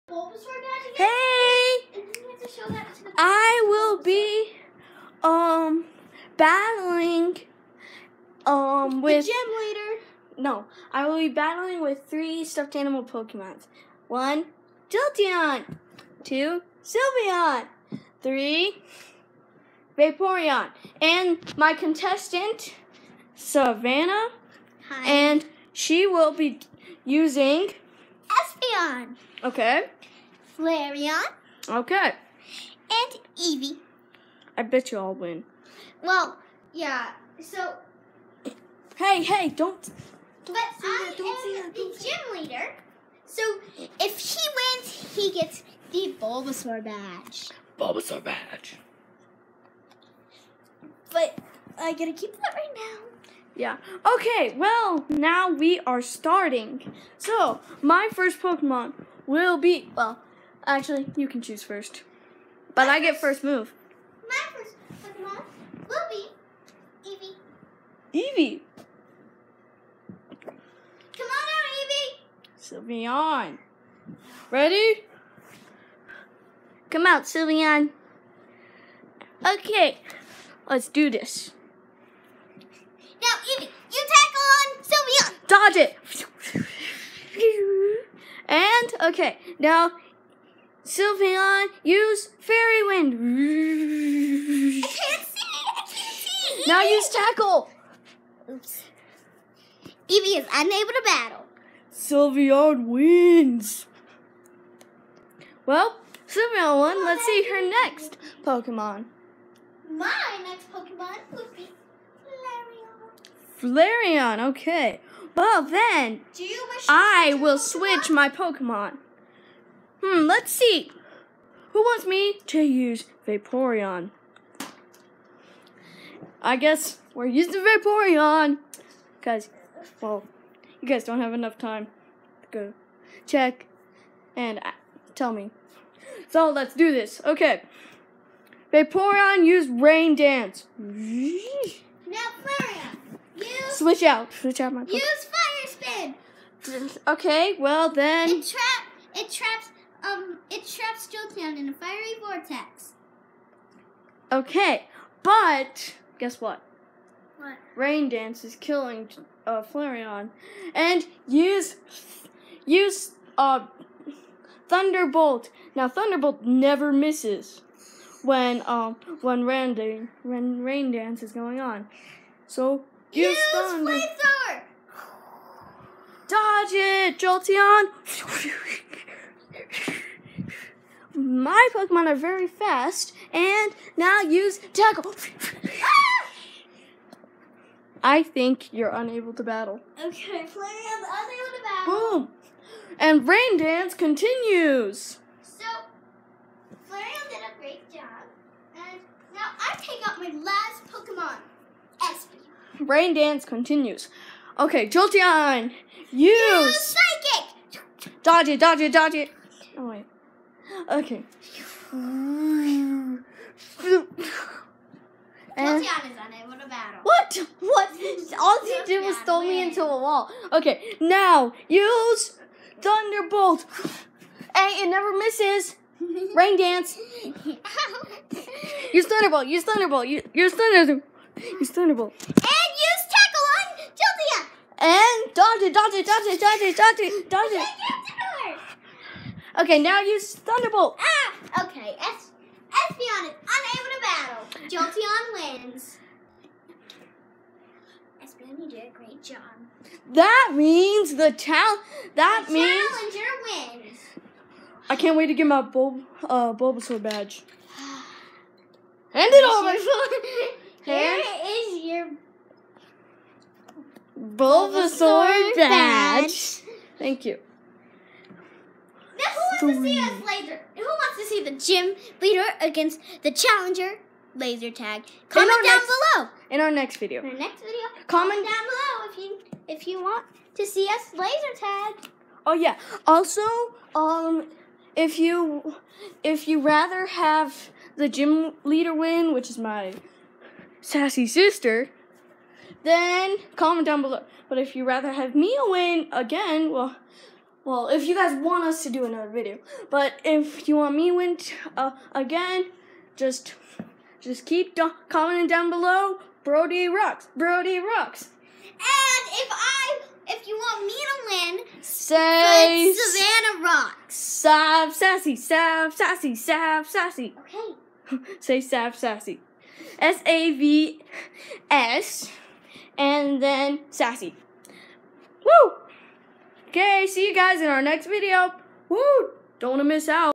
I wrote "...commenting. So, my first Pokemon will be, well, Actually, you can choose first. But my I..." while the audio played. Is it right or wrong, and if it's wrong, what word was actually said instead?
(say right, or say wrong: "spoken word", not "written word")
wrong: "starting", not "commenting".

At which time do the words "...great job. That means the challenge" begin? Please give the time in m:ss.
4:08.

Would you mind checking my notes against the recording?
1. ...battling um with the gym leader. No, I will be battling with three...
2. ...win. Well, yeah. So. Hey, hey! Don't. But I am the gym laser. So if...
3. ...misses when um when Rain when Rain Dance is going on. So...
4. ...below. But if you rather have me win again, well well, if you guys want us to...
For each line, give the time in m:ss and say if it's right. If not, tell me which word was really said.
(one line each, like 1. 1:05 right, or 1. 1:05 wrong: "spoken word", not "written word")
1. 0:06 right
2. 0:35 wrong: "leader", not "laser"
3. 2:46 right
4. 4:54 right.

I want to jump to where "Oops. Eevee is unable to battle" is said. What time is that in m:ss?
1:38.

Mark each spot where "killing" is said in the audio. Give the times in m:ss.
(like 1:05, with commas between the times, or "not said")
2:38.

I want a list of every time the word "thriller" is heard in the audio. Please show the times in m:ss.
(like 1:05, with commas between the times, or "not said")
not said.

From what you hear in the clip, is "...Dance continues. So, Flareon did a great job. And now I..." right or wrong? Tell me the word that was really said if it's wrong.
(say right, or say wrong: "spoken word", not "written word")
right.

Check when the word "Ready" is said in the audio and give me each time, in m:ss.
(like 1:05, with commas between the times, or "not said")
1:14.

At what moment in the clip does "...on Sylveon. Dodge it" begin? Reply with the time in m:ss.
1:24.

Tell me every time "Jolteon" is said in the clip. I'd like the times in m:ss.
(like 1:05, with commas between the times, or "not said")
0:14, 2:31, 2:57, 3:24, 3:53, 4:04.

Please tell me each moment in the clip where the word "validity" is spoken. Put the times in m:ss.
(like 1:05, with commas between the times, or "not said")
not said.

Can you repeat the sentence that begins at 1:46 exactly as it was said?
Oh, Let's see her next Pokemon.